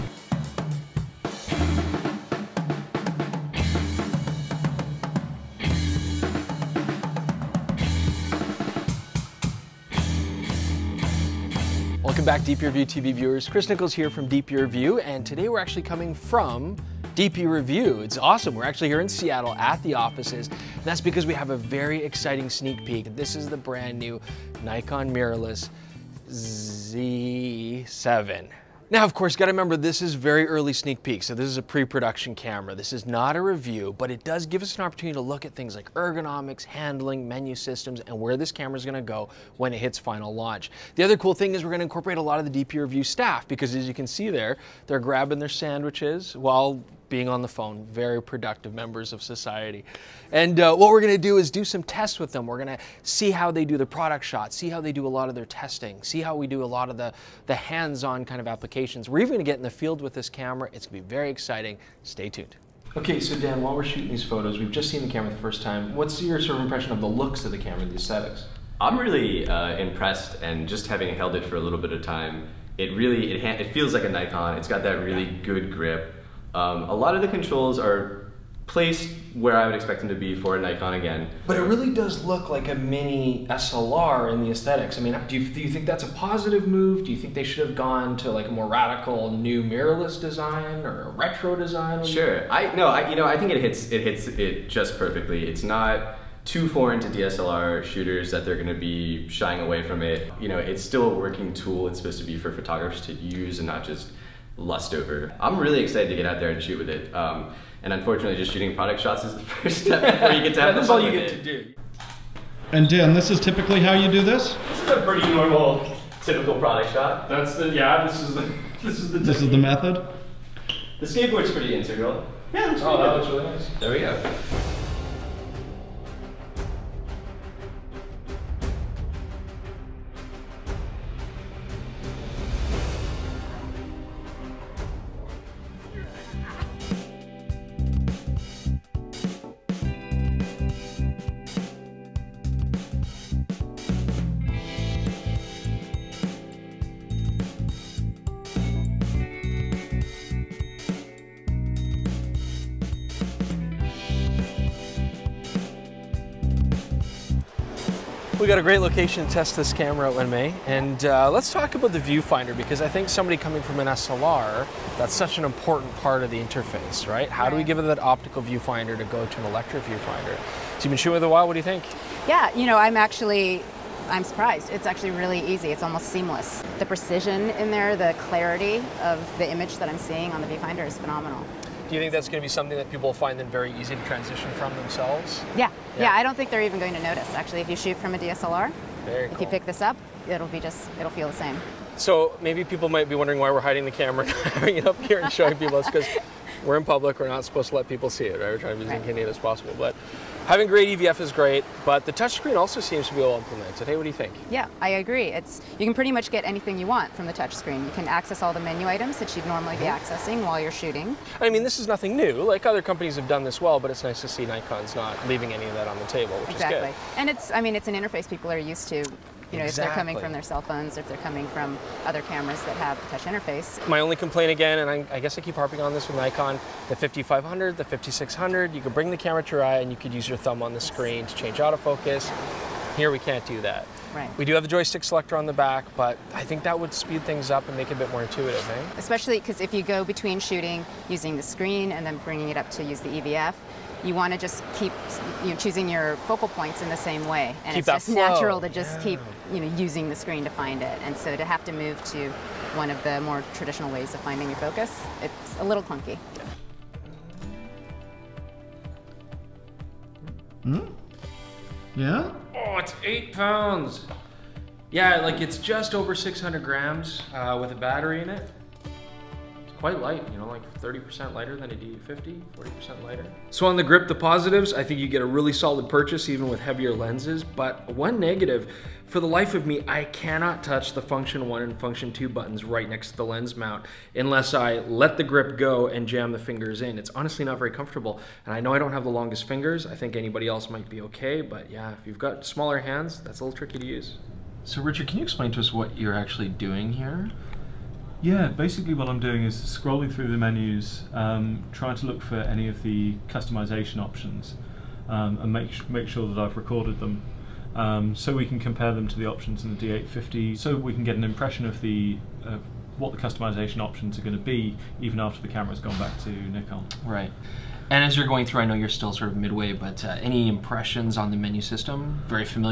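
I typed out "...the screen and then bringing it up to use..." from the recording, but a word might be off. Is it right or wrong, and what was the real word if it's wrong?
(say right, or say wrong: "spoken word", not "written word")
right.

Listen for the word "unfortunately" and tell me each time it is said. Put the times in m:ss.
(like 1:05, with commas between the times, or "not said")
1:47.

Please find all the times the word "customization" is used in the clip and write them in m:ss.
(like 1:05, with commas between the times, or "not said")
5:03, 5:13.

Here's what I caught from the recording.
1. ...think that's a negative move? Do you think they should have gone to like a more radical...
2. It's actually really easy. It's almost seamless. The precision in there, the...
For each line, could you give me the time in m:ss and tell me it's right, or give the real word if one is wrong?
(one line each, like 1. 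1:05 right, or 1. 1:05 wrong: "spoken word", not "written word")
1. 1:25 wrong: "positive", not "negative"
2. 2:54 right.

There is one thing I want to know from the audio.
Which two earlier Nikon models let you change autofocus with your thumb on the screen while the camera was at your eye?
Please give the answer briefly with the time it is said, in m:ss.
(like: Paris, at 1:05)
5500 and 5600, at 3:46.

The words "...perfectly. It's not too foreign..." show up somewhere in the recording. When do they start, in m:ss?
1:34.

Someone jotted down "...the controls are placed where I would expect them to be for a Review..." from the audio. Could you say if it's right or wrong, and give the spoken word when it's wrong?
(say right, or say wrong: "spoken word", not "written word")
wrong: "Nikon", not "Review".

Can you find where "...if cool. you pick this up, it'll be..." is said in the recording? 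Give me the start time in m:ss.
3:09.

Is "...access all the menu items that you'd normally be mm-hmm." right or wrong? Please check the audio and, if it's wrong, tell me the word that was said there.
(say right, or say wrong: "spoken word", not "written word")
right.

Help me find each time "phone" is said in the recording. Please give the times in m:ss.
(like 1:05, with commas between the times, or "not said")
0:47, 3:40.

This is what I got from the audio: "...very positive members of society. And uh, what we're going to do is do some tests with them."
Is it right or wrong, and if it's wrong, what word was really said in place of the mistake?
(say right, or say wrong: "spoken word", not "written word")
wrong: "productive", not "positive".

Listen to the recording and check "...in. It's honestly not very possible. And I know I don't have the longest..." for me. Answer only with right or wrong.
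wrong.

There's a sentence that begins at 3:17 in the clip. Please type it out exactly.
We're not supposed to let people see it.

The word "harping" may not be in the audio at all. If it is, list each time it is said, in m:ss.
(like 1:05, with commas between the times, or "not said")
3:45.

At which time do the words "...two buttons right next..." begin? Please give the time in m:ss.
4:42.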